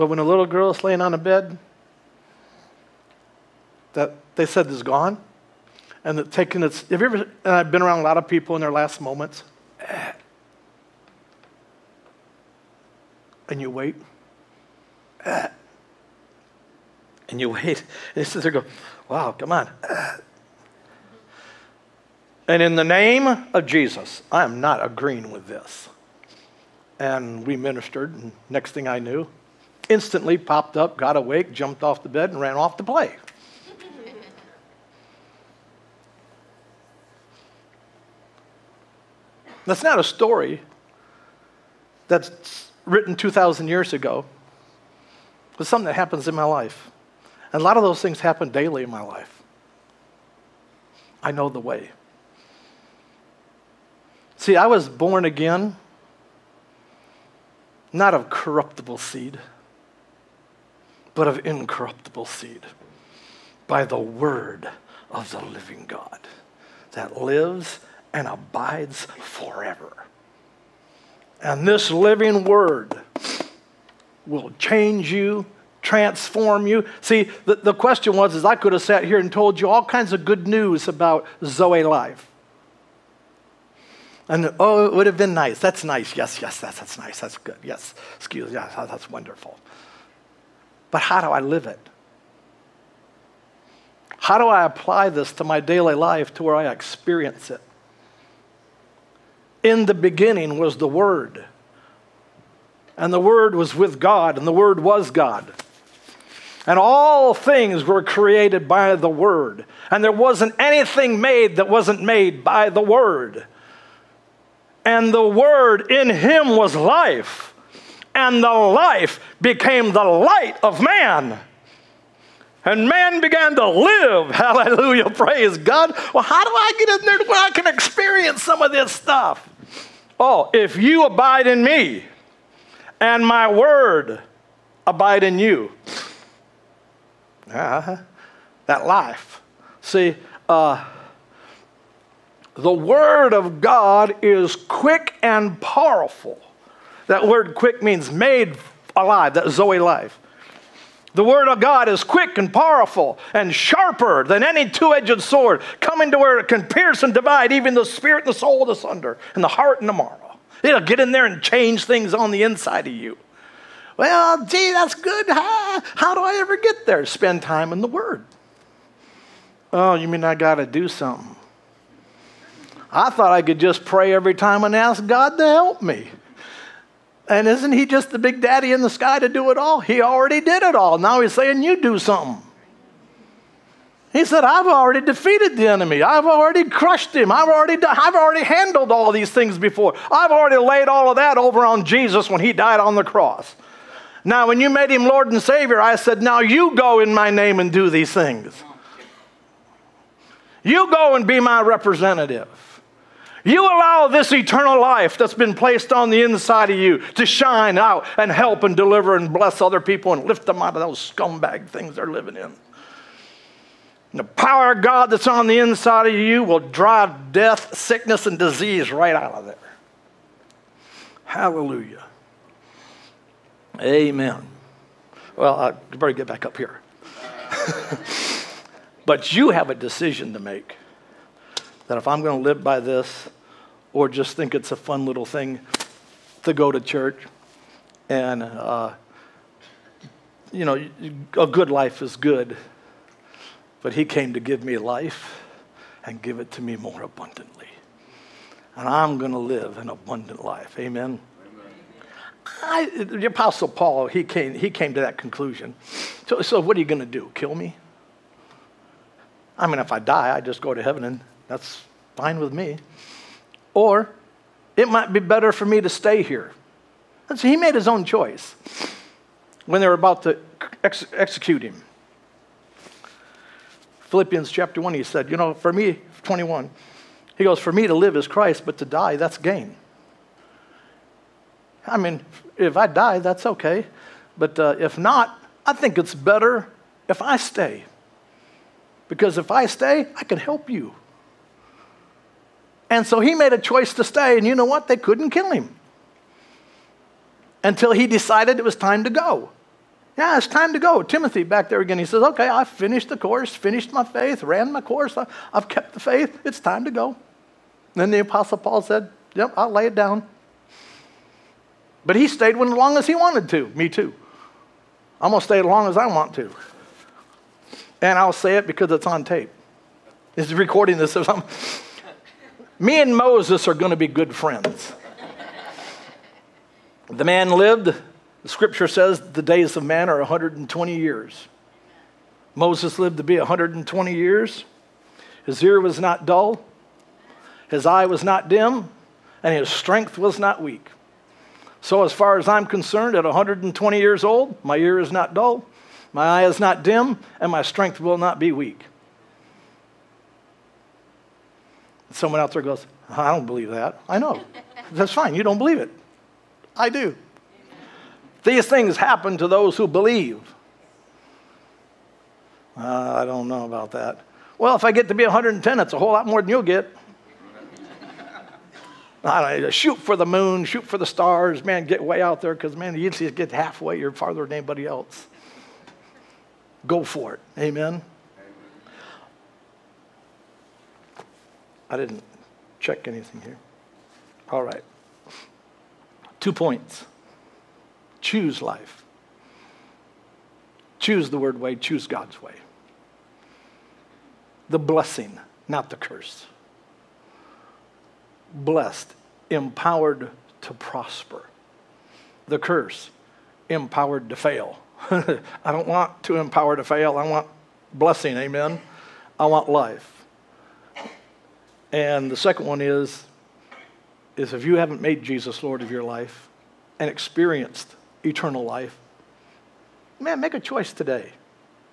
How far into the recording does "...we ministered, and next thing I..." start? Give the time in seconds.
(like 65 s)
27 s.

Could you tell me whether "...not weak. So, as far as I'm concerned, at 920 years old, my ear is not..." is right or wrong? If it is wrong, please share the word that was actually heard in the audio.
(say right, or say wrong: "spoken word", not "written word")
wrong: "120", not "920".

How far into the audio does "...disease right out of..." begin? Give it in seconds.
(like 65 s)
218 s.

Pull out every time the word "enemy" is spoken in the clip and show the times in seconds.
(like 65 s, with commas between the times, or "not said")
185 s.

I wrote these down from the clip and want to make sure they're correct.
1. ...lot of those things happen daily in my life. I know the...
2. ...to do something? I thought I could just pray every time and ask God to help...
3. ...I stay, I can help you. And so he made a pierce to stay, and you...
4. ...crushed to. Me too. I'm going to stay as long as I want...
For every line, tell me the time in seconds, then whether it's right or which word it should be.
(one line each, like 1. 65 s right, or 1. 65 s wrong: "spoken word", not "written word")
1. 47 s right
2. 170 s right
3. 289 s wrong: "choice", not "pierce"
4. 313 s wrong: "wanted", not "crushed".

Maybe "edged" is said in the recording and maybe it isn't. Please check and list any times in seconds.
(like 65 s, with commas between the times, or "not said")
154 s.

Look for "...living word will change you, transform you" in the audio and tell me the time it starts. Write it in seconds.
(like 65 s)
71 s.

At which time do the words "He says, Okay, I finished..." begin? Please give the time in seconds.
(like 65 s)
301 s.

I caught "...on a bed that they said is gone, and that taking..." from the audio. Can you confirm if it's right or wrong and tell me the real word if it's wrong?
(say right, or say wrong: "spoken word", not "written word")
right.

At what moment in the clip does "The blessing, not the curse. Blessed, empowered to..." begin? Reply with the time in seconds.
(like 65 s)
394 s.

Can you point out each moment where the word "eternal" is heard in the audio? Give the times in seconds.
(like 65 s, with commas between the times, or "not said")
204 s, 418 s.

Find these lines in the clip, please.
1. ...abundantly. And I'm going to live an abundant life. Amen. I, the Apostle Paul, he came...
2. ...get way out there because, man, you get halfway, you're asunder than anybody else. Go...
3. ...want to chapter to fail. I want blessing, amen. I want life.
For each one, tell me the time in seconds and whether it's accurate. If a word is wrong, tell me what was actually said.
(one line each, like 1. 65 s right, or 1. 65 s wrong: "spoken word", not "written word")
1. 247 s right
2. 371 s wrong: "farther", not "asunder"
3. 405 s wrong: "empower", not "chapter".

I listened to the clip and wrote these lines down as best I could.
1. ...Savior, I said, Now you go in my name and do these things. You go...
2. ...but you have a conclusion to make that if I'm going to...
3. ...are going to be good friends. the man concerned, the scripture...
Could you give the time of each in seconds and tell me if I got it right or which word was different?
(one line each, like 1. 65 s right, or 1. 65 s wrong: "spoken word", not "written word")
1. 195 s right
2. 229 s wrong: "decision", not "conclusion"
3. 323 s wrong: "lived", not "concerned".